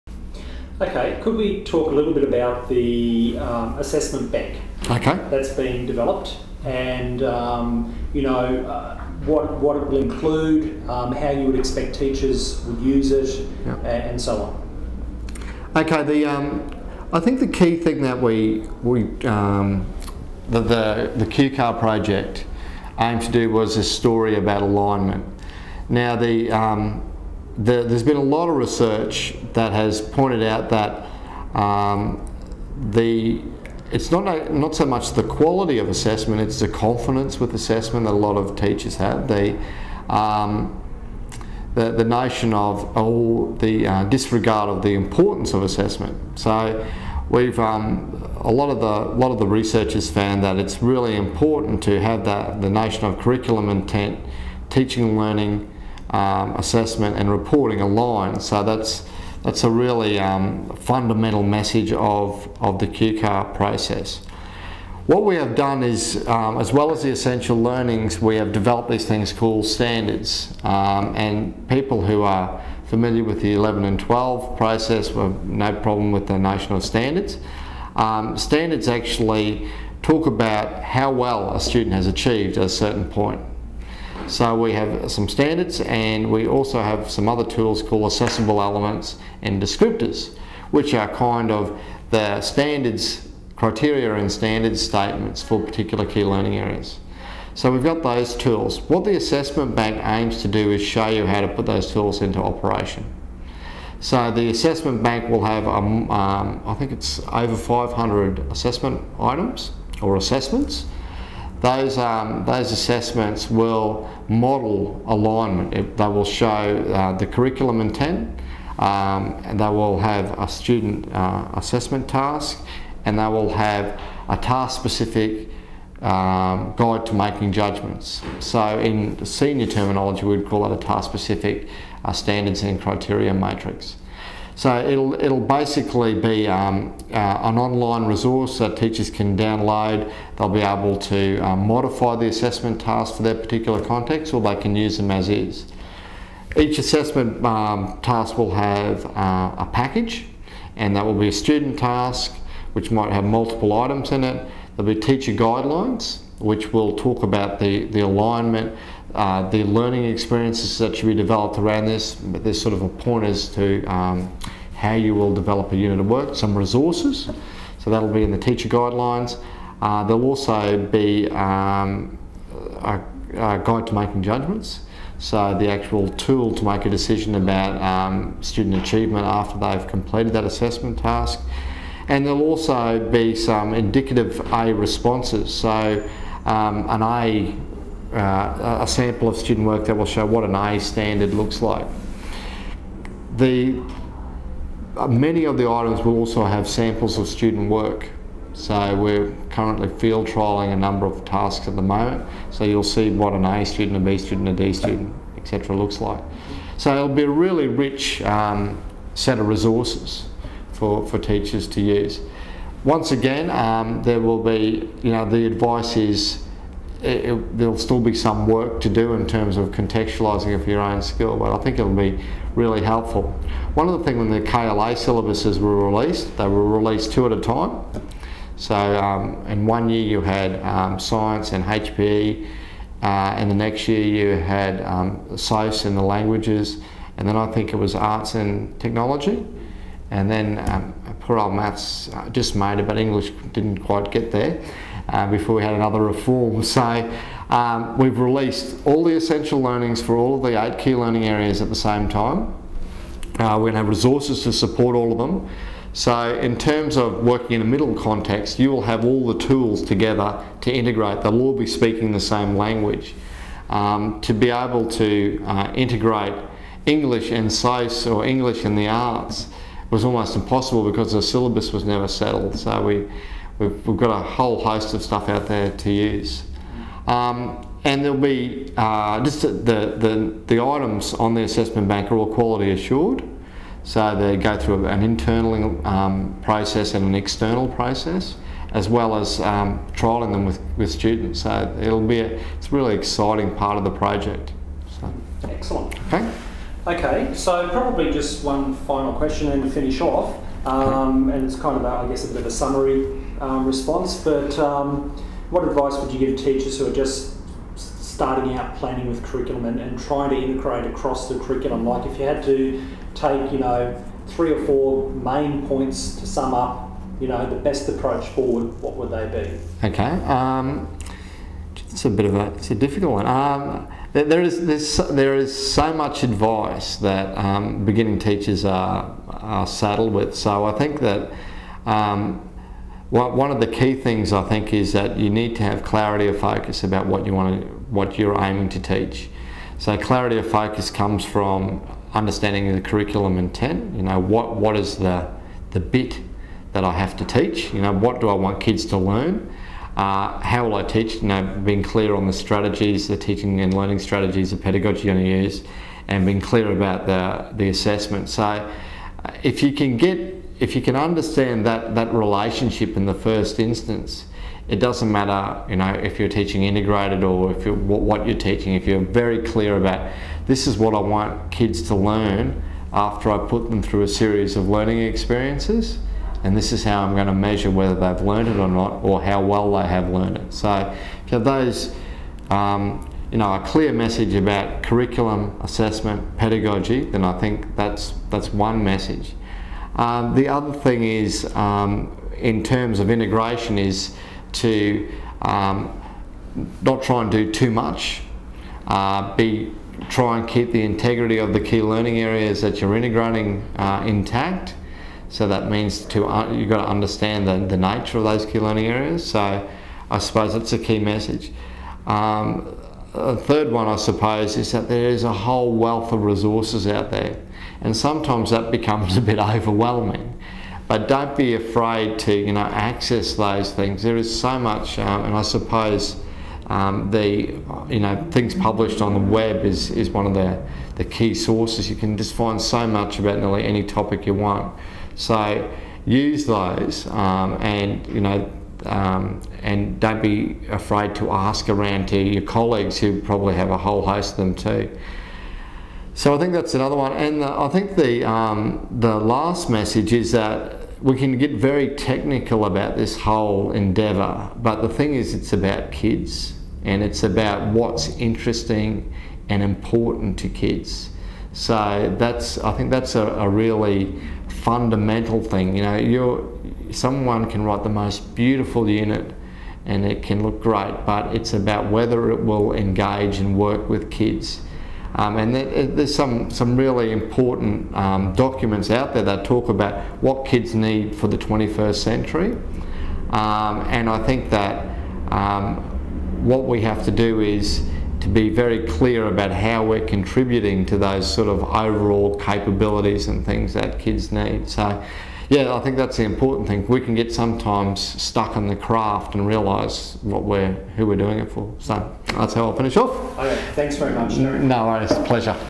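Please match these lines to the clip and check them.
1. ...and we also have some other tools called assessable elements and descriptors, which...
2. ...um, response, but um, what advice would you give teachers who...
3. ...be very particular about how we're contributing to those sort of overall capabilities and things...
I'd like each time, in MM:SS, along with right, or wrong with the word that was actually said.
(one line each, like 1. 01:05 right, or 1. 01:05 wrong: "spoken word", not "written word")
1. 01:25 right
2. 05:03 right
3. 08:08 wrong: "clear", not "particular".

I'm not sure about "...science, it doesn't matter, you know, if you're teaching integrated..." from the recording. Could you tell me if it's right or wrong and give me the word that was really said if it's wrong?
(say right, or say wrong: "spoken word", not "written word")
wrong: "instance", not "science".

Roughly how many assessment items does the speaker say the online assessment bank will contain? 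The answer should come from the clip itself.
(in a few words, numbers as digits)
over 500.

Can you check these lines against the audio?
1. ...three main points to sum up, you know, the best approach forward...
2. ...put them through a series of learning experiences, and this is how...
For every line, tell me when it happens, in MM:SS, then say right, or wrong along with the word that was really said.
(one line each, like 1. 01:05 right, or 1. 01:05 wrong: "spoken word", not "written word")
1. 05:14 wrong: "four", not "three"
2. 06:13 right.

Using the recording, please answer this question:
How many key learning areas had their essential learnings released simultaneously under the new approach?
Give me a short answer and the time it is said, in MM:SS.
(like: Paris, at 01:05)
8, at 04:10.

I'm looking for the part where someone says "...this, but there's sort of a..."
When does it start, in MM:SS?
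02:41.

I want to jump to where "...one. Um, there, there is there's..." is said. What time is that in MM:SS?
05:23.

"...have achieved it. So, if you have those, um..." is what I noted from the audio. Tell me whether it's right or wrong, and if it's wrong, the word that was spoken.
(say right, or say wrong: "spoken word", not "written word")
wrong: "learned", not "achieved".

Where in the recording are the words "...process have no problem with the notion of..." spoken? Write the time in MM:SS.
01:14.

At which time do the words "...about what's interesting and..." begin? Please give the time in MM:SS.
07:37.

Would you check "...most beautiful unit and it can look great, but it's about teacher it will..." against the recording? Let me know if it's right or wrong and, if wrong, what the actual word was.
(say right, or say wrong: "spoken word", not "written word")
wrong: "whether", not "teacher".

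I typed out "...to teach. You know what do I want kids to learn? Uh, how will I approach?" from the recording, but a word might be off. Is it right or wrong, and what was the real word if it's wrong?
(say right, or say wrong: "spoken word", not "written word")
wrong: "teach", not "approach".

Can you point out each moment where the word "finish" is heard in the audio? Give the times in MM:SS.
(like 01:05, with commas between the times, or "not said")
04:59, 08:22.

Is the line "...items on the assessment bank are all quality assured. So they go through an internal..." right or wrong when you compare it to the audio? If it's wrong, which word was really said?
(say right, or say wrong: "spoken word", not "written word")
right.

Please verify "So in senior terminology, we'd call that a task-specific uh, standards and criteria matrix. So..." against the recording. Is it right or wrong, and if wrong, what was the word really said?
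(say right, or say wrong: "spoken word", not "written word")
right.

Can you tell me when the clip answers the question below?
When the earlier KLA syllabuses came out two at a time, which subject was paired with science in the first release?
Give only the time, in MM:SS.
03:51.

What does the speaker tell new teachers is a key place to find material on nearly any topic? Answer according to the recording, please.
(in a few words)
the web.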